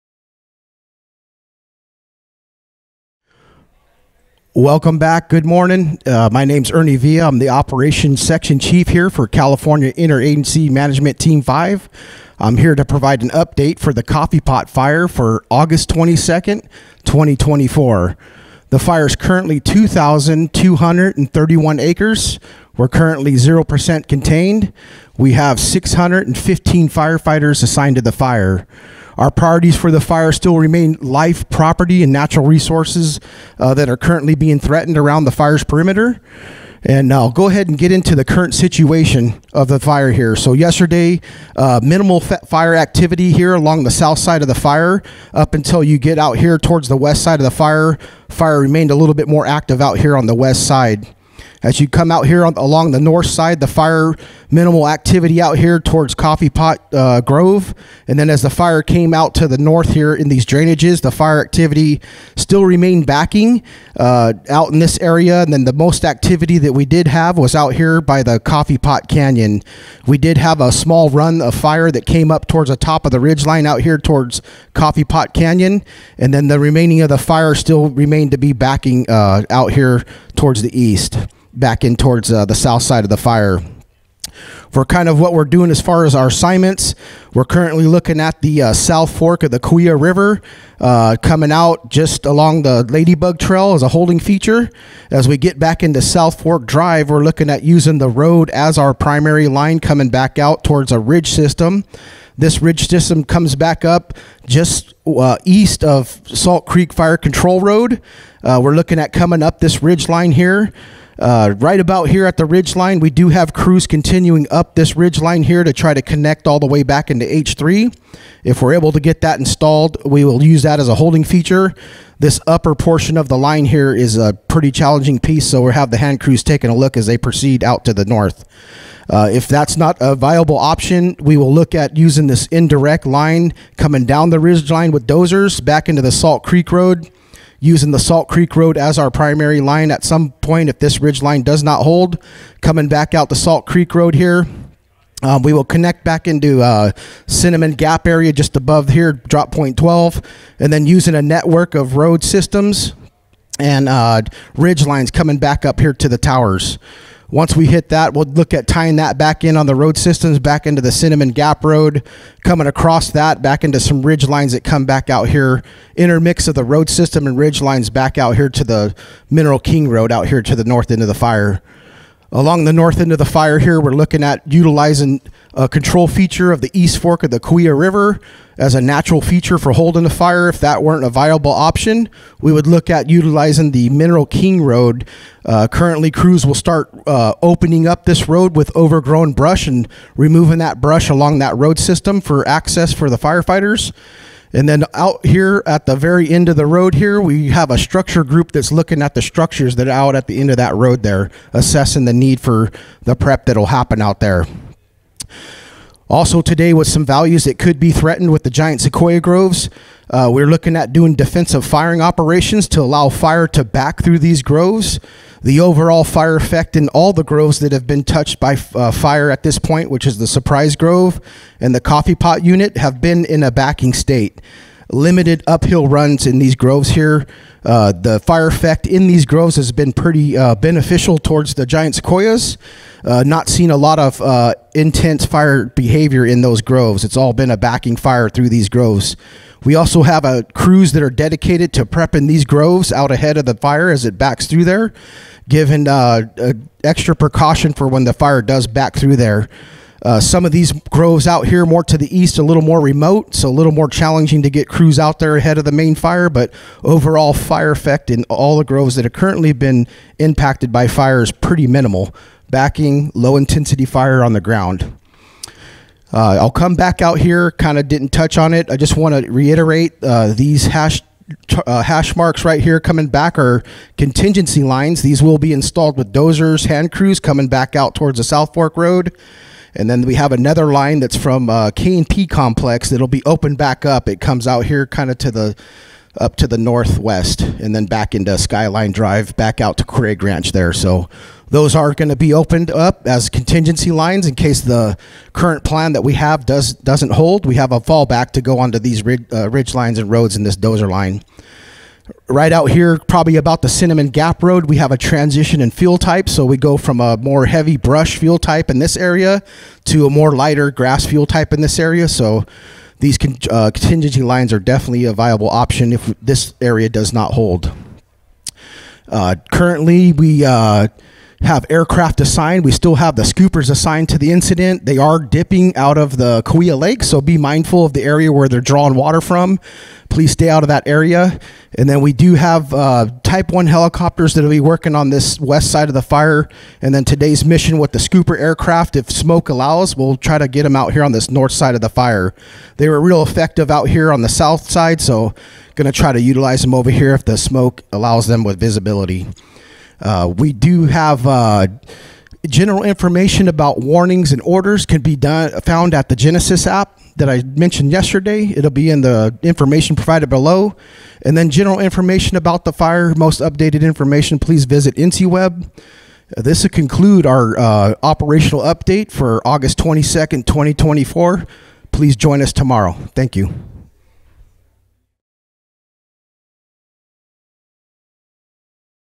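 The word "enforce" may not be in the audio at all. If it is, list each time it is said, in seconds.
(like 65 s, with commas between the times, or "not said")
not said.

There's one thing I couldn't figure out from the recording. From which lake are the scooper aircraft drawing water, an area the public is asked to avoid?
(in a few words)
Kaweah Lake.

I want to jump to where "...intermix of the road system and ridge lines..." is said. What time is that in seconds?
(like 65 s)
165 s.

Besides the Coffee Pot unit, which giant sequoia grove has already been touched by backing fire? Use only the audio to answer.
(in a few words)
Surprise Grove.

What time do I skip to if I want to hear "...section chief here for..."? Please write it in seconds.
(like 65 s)
8 s.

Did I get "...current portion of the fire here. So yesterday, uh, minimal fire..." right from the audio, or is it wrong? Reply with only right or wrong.
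wrong.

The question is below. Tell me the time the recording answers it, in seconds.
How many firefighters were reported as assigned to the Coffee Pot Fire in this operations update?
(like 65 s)
25 s.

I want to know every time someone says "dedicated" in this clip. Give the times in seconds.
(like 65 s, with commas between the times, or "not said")
241 s.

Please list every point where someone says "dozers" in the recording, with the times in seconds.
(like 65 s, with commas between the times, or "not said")
135 s, 276 s, 300 s.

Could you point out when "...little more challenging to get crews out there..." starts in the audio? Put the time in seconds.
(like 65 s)
253 s.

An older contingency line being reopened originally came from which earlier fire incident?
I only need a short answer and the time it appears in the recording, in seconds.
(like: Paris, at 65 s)
KNP Complex, at 281 s.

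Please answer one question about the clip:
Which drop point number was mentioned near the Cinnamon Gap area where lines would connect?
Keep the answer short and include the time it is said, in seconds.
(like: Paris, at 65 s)
12, at 149 s.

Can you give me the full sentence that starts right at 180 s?
If that weren't a viable option, we would look at utilizing the Mineral King Road.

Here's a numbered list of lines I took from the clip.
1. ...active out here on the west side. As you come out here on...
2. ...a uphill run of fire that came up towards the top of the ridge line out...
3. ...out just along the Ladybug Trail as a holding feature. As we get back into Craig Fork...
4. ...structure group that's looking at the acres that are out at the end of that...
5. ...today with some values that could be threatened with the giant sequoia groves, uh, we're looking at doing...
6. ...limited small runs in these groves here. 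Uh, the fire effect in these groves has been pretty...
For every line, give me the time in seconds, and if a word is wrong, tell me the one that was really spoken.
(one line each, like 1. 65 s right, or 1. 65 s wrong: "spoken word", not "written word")
1. 49 s right
2. 70 s wrong: "small", not "uphill"
3. 91 s wrong: "South", not "Craig"
4. 197 s wrong: "structures", not "acres"
5. 206 s right
6. 224 s wrong: "uphill", not "small".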